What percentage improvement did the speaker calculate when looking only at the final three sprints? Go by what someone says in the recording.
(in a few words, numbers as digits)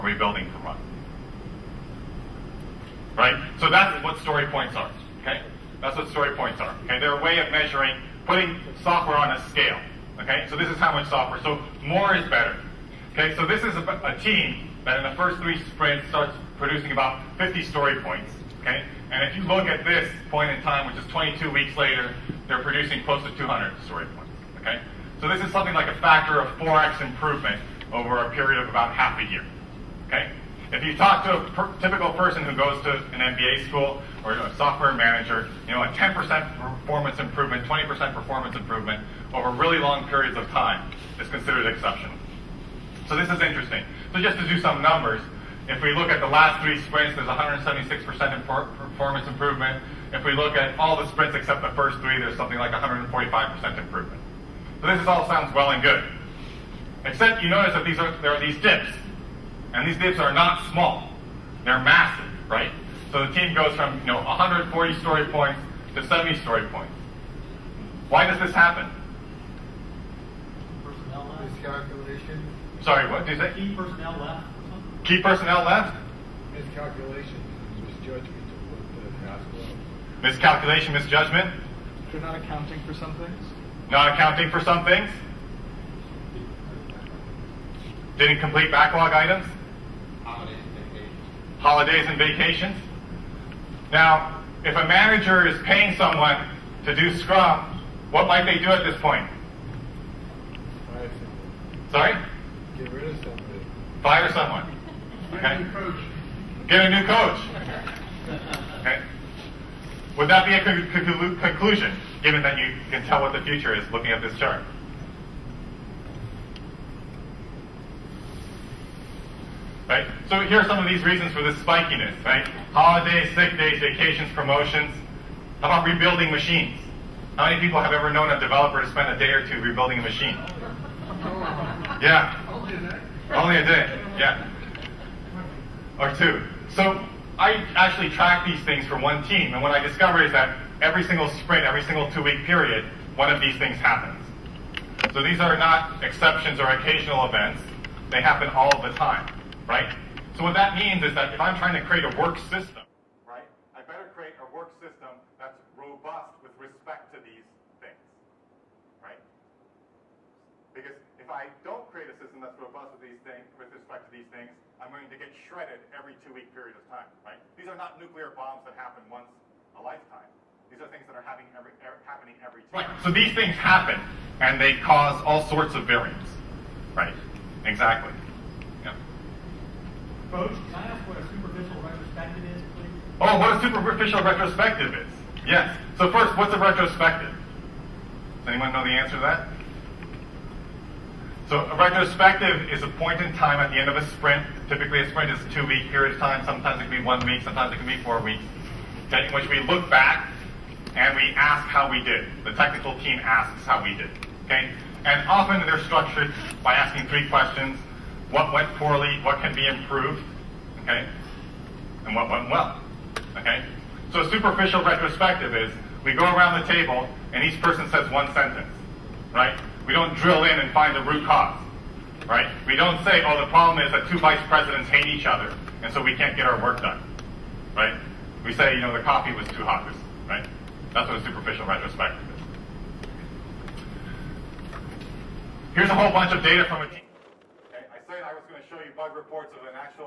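176%.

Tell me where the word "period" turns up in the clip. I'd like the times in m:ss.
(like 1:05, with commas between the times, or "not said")
0:28, 0:40, 2:22, 2:46, 3:15.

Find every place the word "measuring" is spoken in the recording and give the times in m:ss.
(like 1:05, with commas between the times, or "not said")
0:07.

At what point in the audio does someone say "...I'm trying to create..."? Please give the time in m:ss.
2:31.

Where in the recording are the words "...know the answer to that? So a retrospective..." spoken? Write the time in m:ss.
3:08.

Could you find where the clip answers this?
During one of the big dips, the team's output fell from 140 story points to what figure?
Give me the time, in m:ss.
1:06.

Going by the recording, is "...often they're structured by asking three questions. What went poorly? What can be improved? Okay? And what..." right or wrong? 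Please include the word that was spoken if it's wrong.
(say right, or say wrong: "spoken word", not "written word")
right.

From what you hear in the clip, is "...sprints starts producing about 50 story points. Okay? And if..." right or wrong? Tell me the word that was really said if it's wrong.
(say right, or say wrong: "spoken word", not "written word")
right.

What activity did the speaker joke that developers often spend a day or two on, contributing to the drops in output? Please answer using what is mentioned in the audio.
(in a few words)
Rebuilding machines.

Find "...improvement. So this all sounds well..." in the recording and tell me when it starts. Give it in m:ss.
0:53.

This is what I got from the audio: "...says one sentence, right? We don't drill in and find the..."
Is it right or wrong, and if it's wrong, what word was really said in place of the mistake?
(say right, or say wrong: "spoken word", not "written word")
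right.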